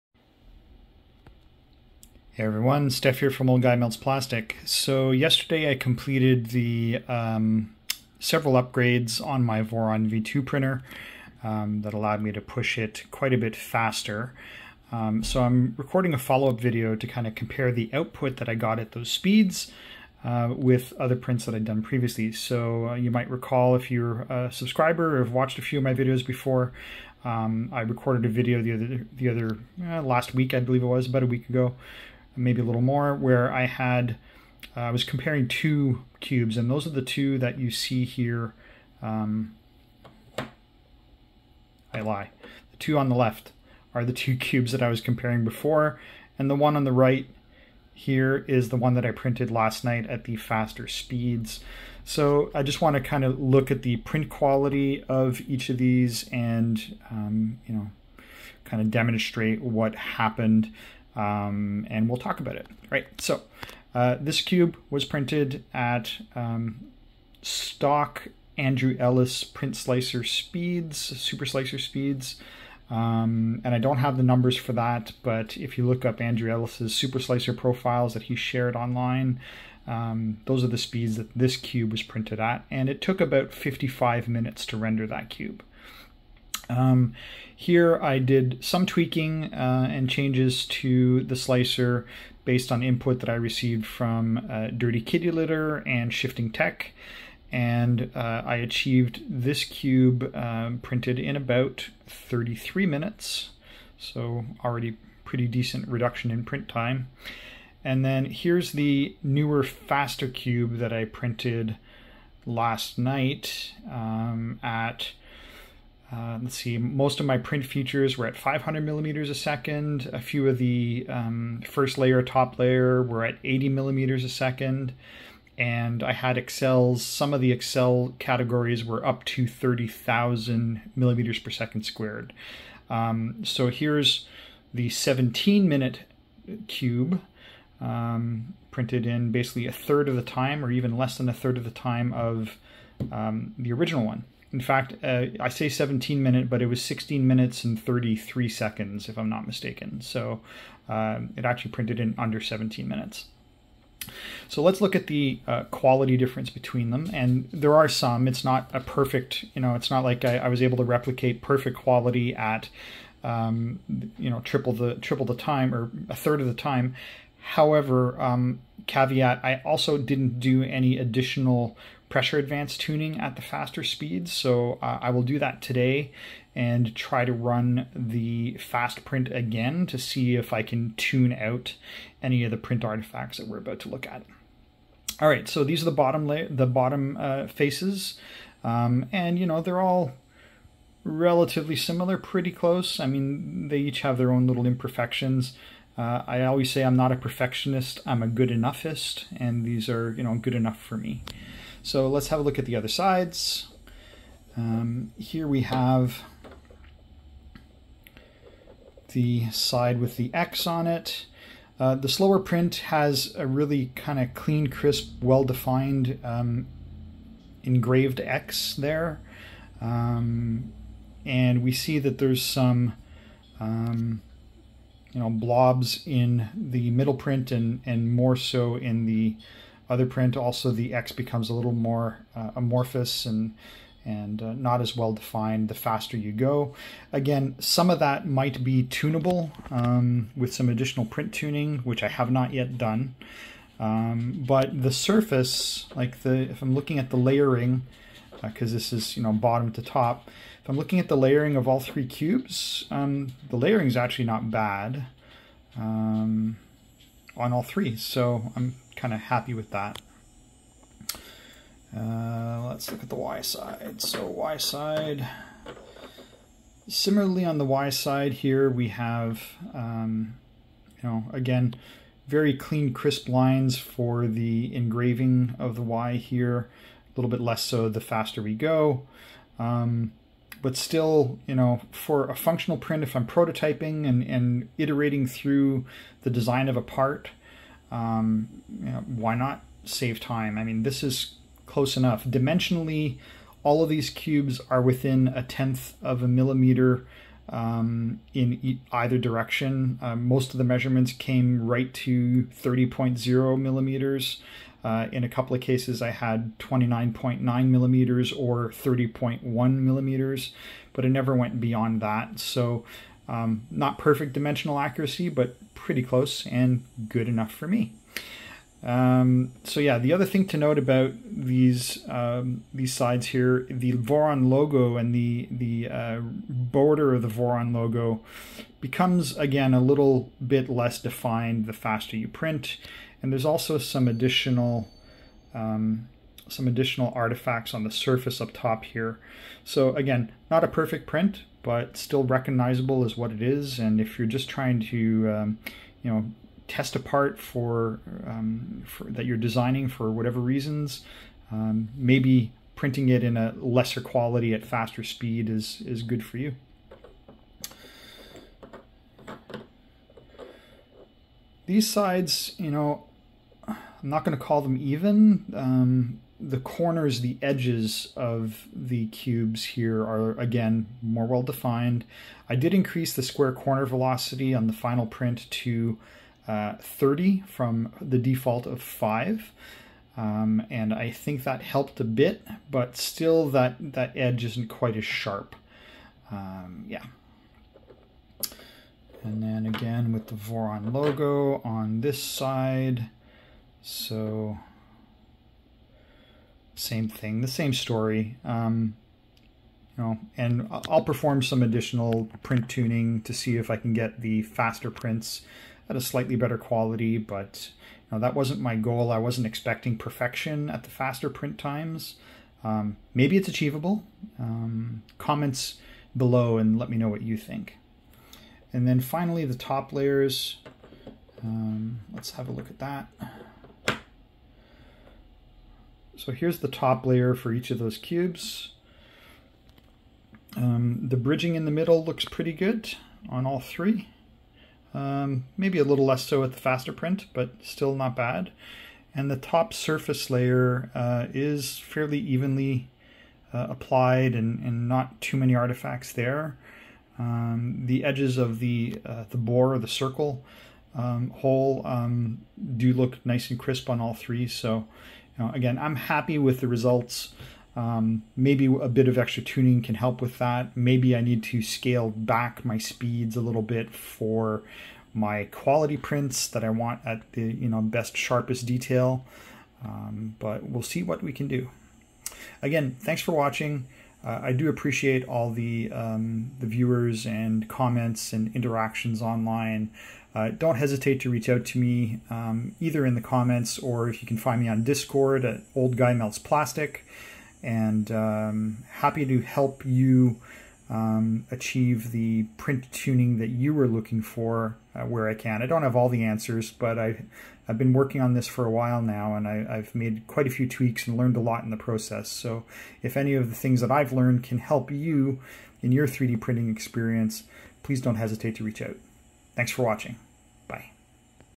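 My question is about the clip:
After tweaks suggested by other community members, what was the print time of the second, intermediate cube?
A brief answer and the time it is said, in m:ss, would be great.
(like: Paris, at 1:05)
33 minutes, at 1:42.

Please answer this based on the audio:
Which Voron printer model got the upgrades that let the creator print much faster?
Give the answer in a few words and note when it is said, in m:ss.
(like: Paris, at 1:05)
V2, at 0:09.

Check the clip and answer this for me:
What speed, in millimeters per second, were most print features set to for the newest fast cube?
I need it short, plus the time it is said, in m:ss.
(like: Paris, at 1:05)
500 mm/s, at 1:58.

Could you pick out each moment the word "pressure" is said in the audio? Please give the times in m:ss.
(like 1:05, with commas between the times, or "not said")
2:52.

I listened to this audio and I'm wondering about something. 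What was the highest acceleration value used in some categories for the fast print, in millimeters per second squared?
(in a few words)
30,000.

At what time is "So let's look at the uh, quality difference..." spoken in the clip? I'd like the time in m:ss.
2:34.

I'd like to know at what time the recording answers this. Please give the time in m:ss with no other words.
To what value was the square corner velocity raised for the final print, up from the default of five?
6:16.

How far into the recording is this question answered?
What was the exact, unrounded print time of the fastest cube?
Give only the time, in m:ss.
2:26.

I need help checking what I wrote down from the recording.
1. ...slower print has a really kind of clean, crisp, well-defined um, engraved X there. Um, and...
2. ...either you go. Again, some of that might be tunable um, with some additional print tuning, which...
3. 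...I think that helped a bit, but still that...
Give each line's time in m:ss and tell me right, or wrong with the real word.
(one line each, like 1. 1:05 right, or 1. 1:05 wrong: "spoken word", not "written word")
1. 3:32 right
2. 3:55 wrong: "faster", not "either"
3. 6:20 right.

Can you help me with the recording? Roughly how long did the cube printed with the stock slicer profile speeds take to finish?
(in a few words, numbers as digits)
55 minutes.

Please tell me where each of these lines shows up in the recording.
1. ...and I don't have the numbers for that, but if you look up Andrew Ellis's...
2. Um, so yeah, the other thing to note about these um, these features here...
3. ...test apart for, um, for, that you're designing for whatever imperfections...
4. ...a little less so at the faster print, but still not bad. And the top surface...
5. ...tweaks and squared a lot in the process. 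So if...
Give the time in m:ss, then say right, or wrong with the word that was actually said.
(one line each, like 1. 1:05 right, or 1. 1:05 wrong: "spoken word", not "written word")
1. 1:13 right
2. 5:18 wrong: "sides", not "features"
3. 5:46 wrong: "reasons", not "imperfections"
4. 7:15 right
5. 8:20 wrong: "learned", not "squared".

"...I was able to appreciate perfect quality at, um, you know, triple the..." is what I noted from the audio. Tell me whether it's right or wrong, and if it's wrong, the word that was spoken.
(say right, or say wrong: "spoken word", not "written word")
wrong: "replicate", not "appreciate".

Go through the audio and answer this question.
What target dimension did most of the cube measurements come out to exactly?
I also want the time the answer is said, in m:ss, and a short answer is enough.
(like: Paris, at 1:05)
30.0 mm, at 5:02.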